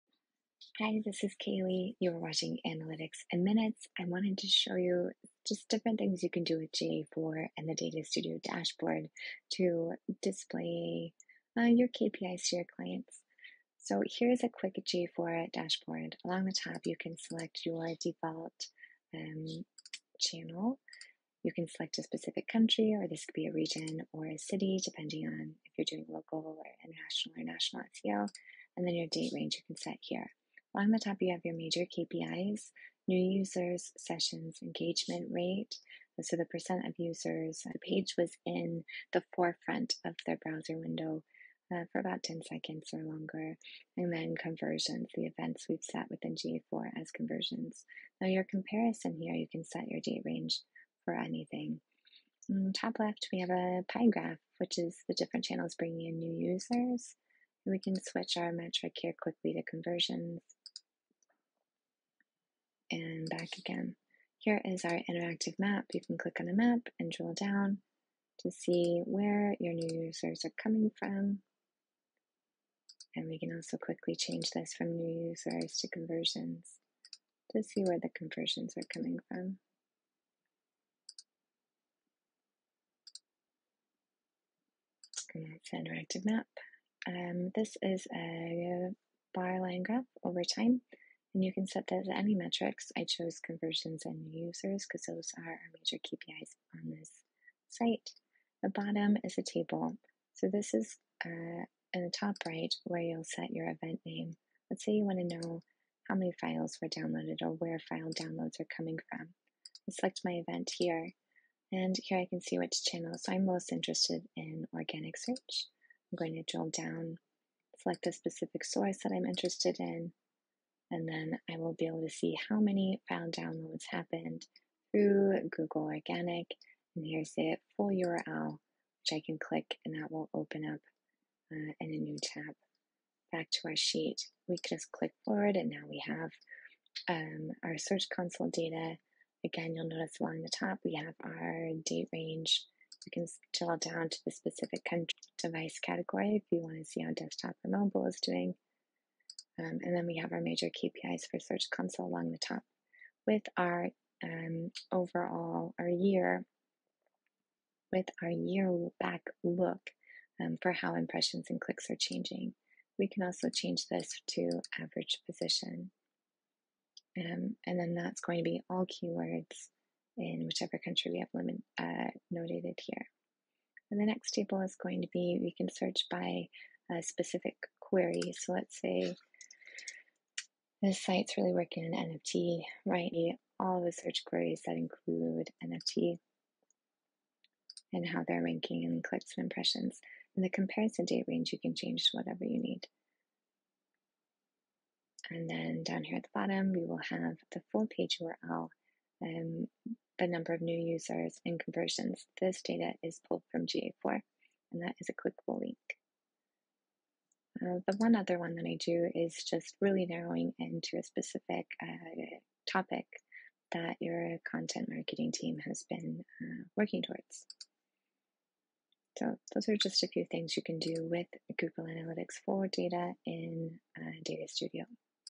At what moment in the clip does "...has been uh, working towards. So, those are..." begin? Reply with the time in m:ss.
3:35.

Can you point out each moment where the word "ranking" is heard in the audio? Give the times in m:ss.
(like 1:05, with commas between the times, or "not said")
3:08.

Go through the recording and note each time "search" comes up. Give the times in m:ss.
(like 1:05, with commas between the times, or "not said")
1:55, 2:17, 2:31, 2:55, 3:03.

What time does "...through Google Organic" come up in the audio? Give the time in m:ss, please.
2:04.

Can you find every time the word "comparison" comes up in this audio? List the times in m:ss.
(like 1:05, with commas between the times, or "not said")
0:48, 3:10.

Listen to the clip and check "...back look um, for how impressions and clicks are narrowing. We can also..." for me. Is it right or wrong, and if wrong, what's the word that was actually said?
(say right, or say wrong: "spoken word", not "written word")
wrong: "changing", not "narrowing".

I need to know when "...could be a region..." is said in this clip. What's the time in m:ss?
0:23.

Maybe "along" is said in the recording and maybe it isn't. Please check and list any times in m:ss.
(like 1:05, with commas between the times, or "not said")
0:16, 0:30, 2:20, 2:32.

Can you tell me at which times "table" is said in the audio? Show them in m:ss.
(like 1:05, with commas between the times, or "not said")
1:39, 2:54.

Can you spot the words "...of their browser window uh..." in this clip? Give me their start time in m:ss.
0:40.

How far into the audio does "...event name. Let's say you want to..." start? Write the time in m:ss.
1:43.